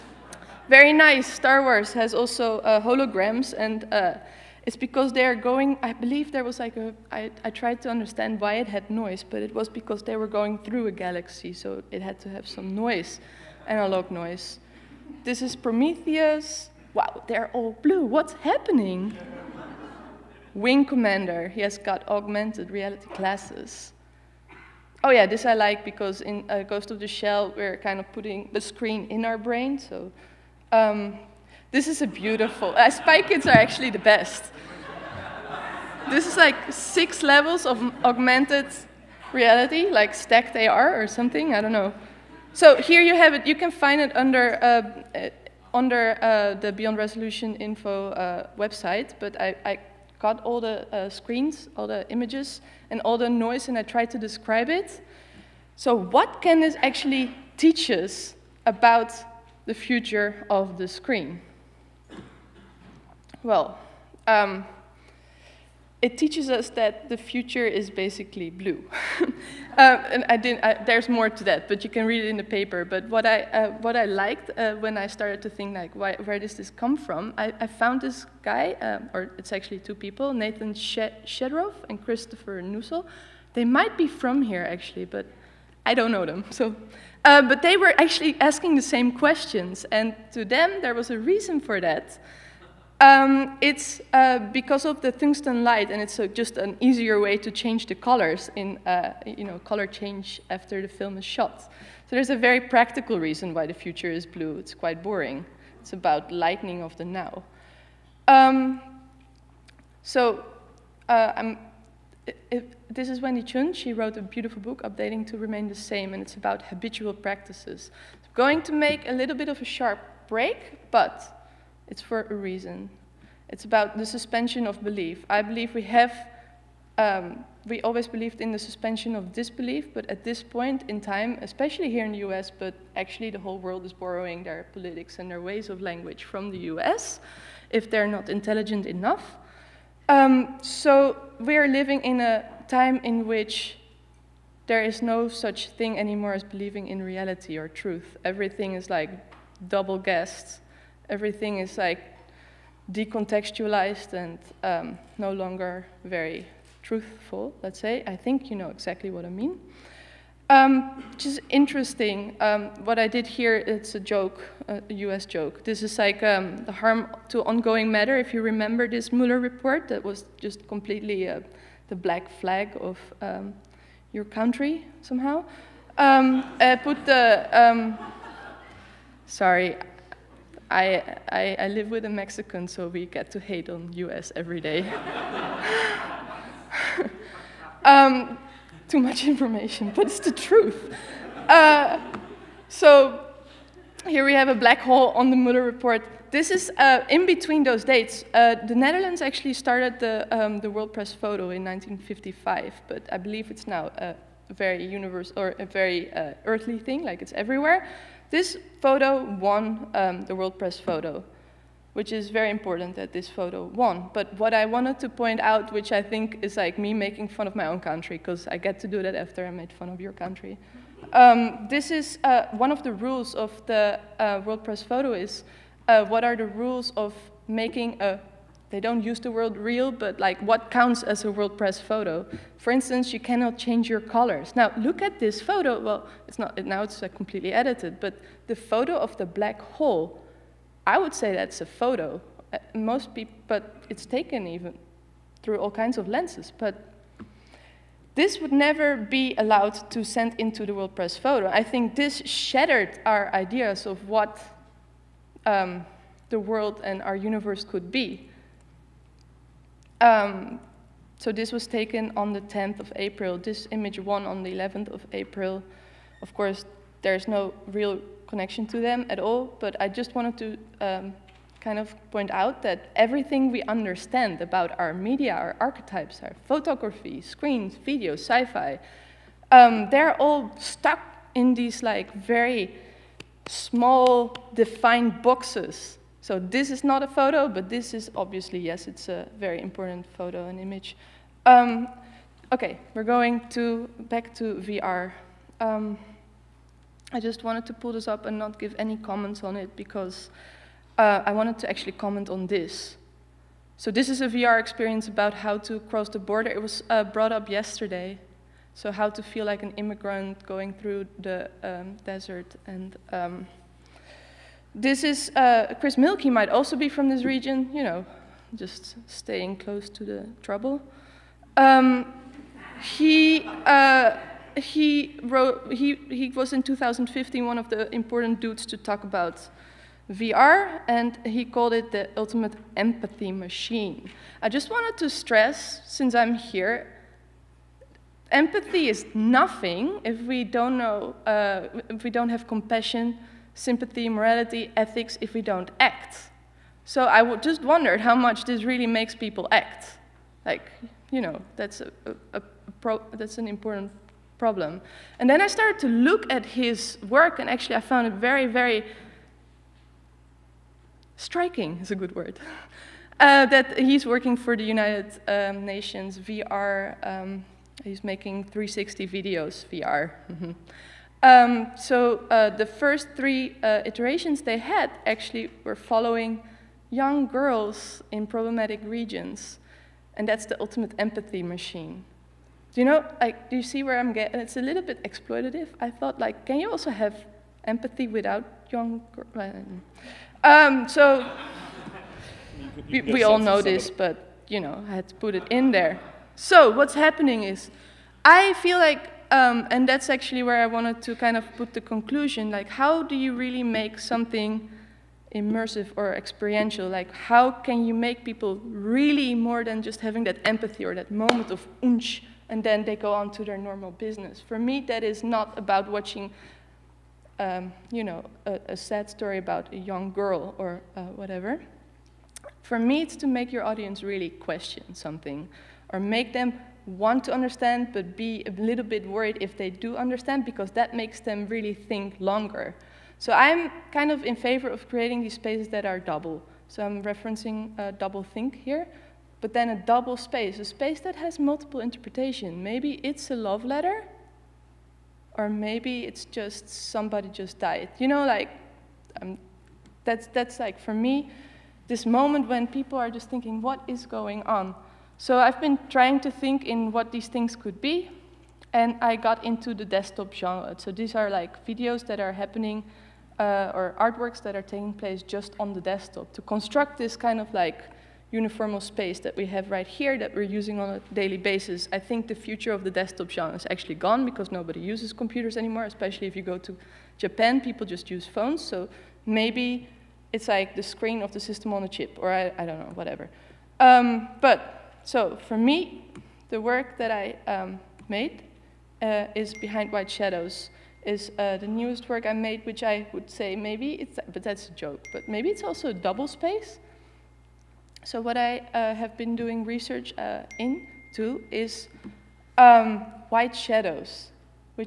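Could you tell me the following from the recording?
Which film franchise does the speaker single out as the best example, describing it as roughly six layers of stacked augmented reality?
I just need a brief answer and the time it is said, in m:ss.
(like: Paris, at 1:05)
Spy Kids, at 0:32.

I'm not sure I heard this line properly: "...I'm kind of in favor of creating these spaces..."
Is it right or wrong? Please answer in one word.
right.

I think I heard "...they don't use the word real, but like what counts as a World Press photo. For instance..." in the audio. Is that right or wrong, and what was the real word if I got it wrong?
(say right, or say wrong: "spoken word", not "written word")
right.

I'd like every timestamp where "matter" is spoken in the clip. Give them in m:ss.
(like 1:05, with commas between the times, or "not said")
2:47.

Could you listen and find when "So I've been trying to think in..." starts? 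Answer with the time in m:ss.
7:35.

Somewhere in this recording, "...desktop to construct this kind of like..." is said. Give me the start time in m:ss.
7:45.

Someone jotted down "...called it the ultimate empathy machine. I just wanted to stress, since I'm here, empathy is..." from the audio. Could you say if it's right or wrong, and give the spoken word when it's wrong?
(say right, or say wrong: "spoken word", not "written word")
right.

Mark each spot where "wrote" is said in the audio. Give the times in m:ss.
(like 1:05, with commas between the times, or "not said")
1:53, 5:25.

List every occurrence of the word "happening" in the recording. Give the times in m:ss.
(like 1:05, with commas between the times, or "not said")
0:18, 6:36, 7:42.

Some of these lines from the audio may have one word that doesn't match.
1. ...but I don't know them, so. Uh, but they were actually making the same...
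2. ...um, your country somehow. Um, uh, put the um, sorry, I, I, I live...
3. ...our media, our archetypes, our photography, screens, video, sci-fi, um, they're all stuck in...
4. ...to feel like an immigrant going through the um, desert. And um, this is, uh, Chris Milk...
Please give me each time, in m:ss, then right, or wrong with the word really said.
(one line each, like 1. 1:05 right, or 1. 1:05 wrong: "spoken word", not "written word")
1. 1:25 wrong: "asking", not "making"
2. 2:53 right
3. 4:34 right
4. 5:09 right.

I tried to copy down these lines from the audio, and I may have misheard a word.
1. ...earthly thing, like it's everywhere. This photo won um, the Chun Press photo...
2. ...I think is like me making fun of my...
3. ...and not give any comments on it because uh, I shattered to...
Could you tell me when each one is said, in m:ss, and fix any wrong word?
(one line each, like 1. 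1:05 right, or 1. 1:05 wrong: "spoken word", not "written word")
1. 3:26 wrong: "World", not "Chun"
2. 3:35 right
3. 4:58 wrong: "wanted", not "shattered".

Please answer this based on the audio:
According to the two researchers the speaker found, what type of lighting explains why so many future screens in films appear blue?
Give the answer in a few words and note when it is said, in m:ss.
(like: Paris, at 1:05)
Tungsten light, at 1:35.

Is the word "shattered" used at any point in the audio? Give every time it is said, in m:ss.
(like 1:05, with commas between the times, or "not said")
4:12.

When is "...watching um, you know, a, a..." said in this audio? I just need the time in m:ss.
6:55.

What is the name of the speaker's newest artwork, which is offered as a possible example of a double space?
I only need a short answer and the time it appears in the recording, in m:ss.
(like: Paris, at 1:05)
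Behind White Shadows, at 8:09.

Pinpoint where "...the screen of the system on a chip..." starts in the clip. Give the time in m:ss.
8:00.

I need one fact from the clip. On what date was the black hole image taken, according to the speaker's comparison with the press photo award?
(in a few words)
10 April.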